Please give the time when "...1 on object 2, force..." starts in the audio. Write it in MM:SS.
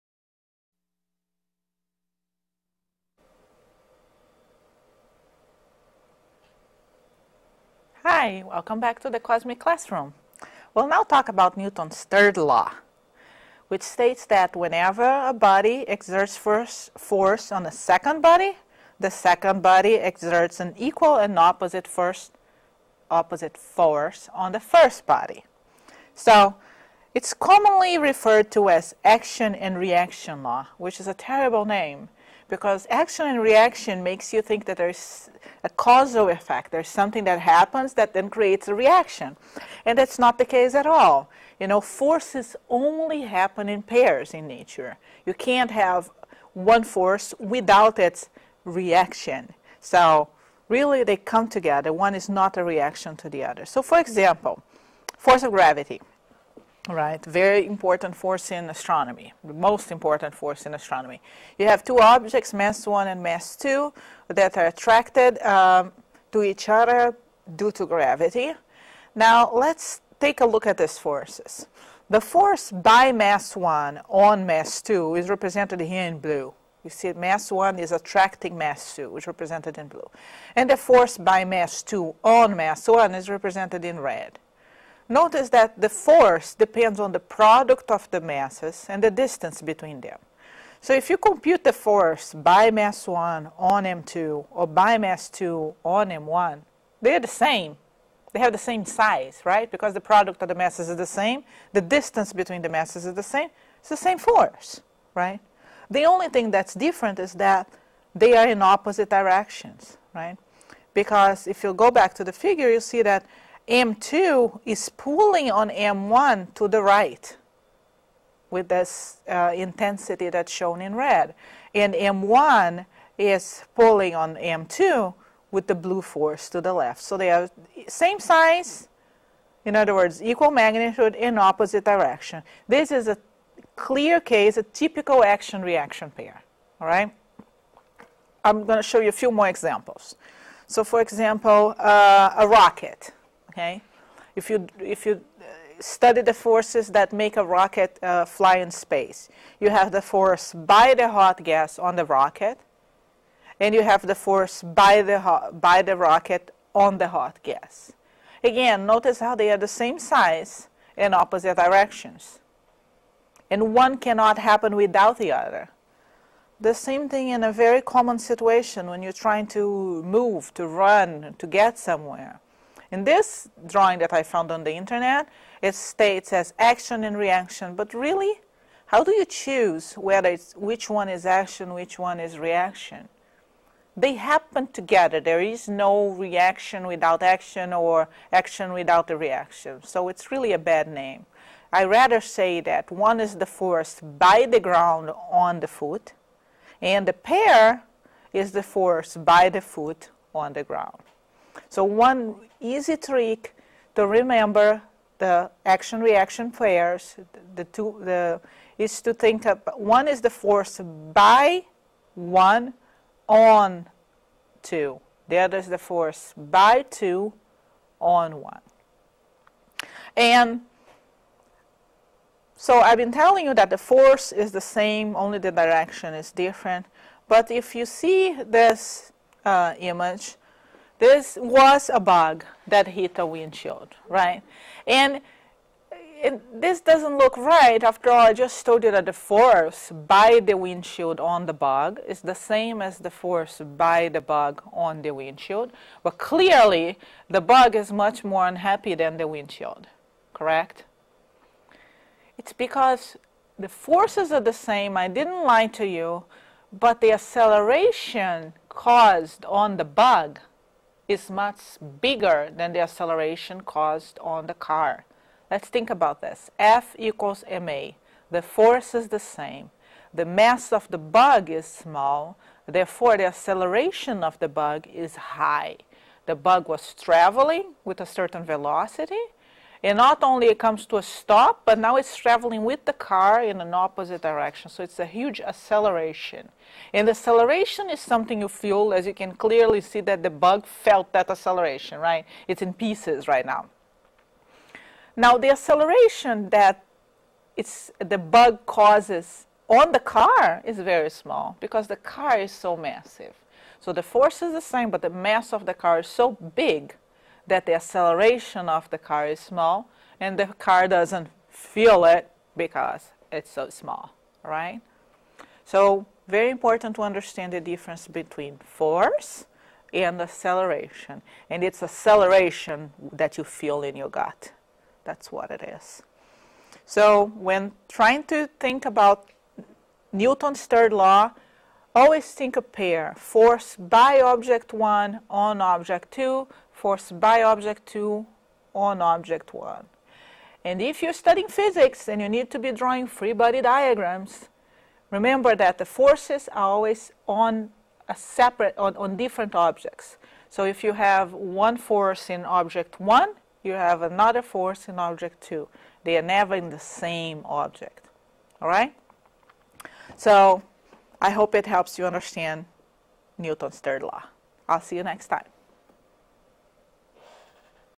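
05:34.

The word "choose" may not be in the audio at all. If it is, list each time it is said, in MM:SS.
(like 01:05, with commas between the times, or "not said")
02:59.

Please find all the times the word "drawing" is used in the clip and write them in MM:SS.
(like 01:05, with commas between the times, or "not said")
02:53, 05:42.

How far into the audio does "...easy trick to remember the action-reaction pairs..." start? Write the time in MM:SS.
03:22.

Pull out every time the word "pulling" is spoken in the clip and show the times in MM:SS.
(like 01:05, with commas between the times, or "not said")
01:54, 02:03.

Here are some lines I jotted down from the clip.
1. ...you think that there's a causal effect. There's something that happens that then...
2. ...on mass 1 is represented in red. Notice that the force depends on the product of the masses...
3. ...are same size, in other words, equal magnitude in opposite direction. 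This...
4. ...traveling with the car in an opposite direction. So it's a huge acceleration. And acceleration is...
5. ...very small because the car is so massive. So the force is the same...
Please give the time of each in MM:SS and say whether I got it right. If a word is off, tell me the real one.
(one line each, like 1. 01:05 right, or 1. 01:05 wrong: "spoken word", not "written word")
1. 00:34 right
2. 01:22 right
3. 02:07 right
4. 04:42 right
5. 05:00 right.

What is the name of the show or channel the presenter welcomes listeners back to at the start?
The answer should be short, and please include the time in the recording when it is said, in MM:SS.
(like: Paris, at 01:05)
Cosmic Classroom, at 00:09.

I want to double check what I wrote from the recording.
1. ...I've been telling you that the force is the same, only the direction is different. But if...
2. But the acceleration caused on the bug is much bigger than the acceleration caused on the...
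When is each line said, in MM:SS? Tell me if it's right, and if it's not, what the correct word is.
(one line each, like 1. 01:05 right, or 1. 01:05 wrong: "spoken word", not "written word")
1. 03:42 right
2. 04:16 right.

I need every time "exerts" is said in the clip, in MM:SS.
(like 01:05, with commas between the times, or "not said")
00:15, 00:19.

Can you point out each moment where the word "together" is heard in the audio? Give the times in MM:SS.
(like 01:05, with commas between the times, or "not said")
00:51, 03:04.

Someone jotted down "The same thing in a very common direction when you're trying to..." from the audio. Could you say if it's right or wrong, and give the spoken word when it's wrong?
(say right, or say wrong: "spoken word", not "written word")
wrong: "situation", not "direction".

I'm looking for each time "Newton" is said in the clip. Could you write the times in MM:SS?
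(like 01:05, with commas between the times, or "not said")
00:11, 05:30, 06:03.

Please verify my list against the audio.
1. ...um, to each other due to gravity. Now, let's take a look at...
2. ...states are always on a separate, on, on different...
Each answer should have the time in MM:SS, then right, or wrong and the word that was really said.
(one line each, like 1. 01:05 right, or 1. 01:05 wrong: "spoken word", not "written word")
1. 01:05 right
2. 05:45 wrong: "forces", not "states".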